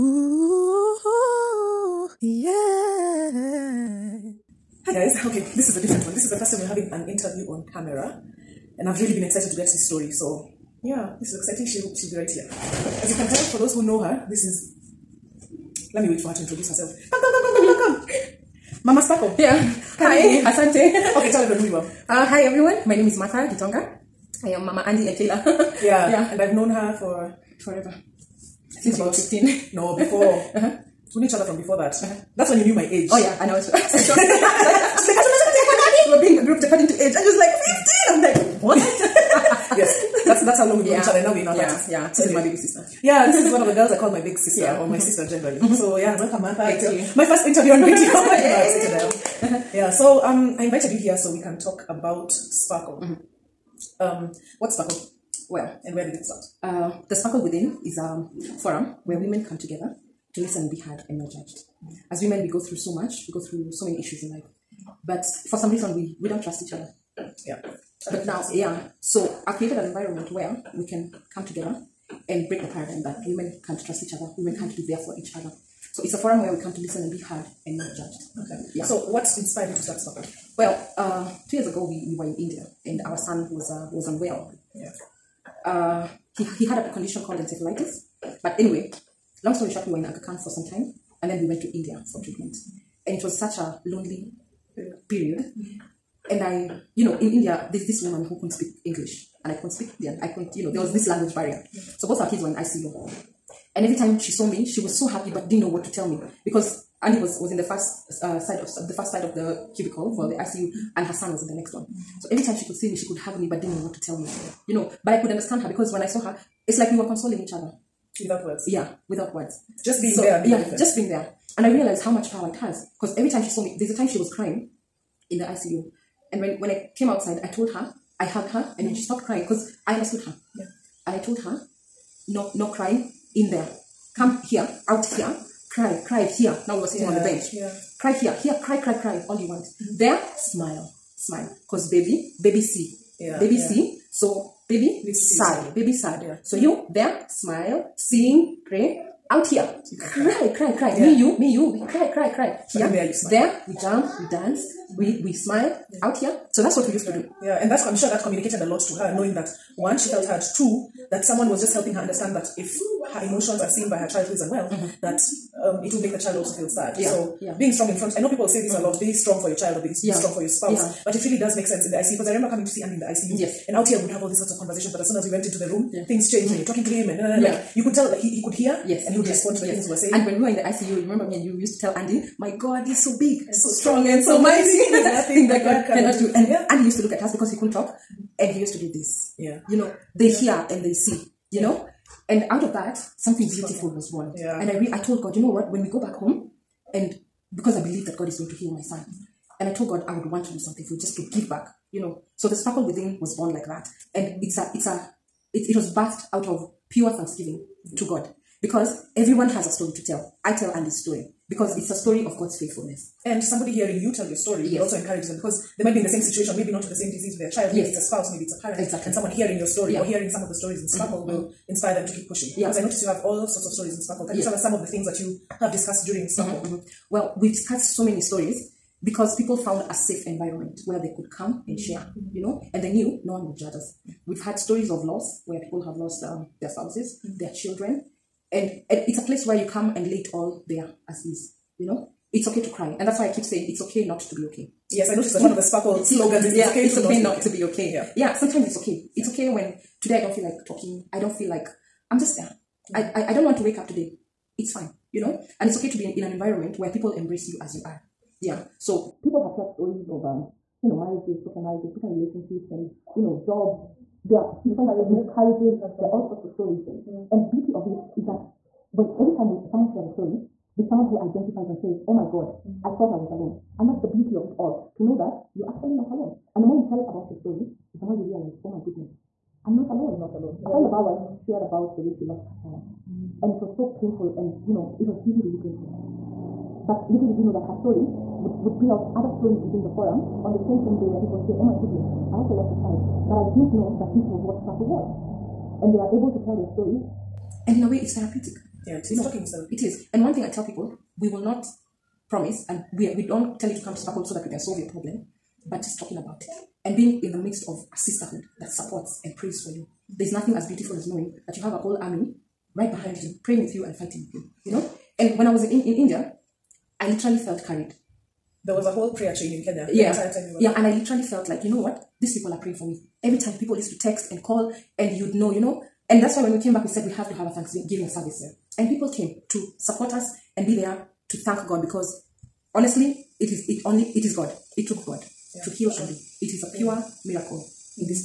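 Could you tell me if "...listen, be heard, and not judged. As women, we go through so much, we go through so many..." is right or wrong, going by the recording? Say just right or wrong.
right.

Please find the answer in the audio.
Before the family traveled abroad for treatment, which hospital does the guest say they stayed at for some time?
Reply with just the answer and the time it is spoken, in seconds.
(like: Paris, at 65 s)
Aga Khan, at 90 s.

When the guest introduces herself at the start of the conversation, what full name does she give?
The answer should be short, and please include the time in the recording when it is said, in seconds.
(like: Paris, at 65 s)
Martha Gitonga, at 23 s.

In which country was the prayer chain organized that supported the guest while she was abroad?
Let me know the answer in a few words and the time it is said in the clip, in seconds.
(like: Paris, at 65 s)
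Kenya, at 319 s.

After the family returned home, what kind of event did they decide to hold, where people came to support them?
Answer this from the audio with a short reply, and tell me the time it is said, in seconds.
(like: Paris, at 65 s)
Thanksgiving service, at 327 s.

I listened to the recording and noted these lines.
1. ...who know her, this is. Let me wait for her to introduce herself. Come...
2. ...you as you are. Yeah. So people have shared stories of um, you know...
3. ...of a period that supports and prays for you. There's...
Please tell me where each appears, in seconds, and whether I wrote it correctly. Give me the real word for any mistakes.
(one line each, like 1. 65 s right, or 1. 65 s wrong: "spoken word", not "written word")
1. 13 s right
2. 257 s right
3. 307 s wrong: "sisterhood", not "period".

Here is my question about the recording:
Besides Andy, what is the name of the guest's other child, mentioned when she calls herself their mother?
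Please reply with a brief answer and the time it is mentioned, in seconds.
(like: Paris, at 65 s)
Taylor, at 25 s.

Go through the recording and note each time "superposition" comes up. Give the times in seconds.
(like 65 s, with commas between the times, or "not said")
not said.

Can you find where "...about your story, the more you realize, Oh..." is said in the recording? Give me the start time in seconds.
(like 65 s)
276 s.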